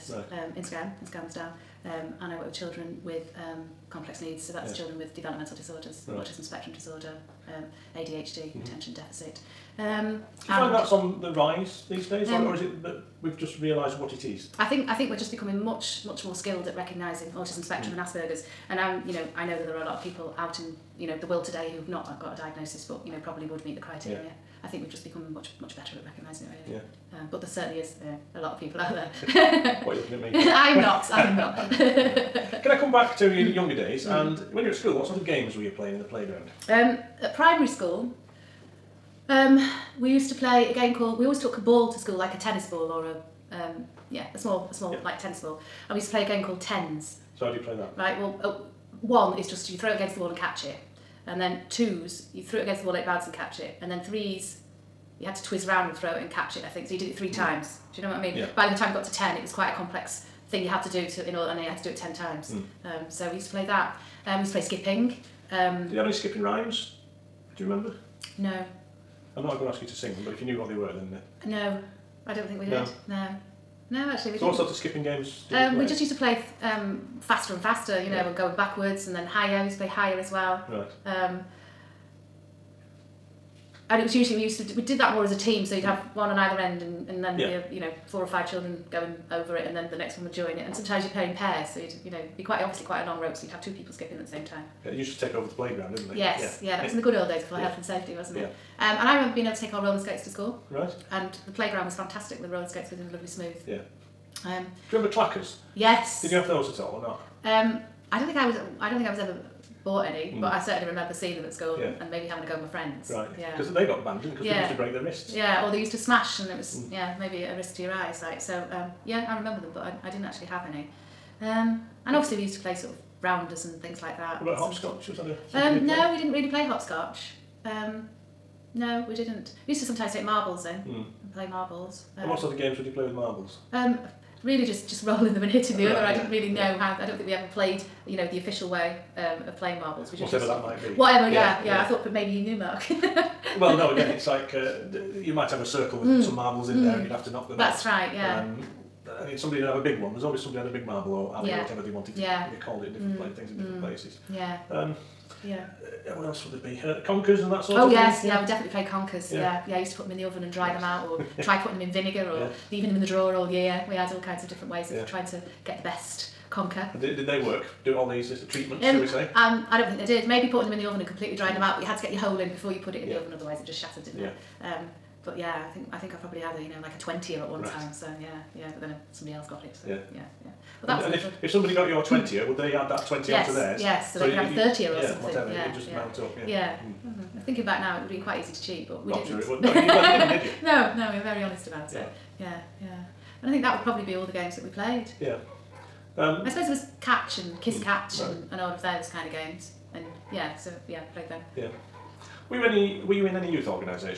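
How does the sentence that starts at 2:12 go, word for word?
Um, and what sort of games would you play with marbles?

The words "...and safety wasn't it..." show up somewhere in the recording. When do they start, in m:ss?
1:37.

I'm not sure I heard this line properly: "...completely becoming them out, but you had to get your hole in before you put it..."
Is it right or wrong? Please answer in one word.
wrong.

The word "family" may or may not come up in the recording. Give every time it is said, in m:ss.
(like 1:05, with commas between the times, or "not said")
not said.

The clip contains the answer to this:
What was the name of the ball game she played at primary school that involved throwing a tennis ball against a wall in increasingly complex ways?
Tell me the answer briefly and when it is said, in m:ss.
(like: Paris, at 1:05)
tens, at 0:46.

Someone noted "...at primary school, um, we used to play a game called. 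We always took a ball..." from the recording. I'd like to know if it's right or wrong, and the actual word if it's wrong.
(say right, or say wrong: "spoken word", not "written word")
right.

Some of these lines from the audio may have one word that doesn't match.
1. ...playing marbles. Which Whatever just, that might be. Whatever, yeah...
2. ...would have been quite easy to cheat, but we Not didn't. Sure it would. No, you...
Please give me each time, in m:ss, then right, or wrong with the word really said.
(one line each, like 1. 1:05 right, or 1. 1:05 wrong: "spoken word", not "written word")
1. 2:19 right
2. 3:08 right.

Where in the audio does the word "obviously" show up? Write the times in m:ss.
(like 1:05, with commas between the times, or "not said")
1:32, 2:02.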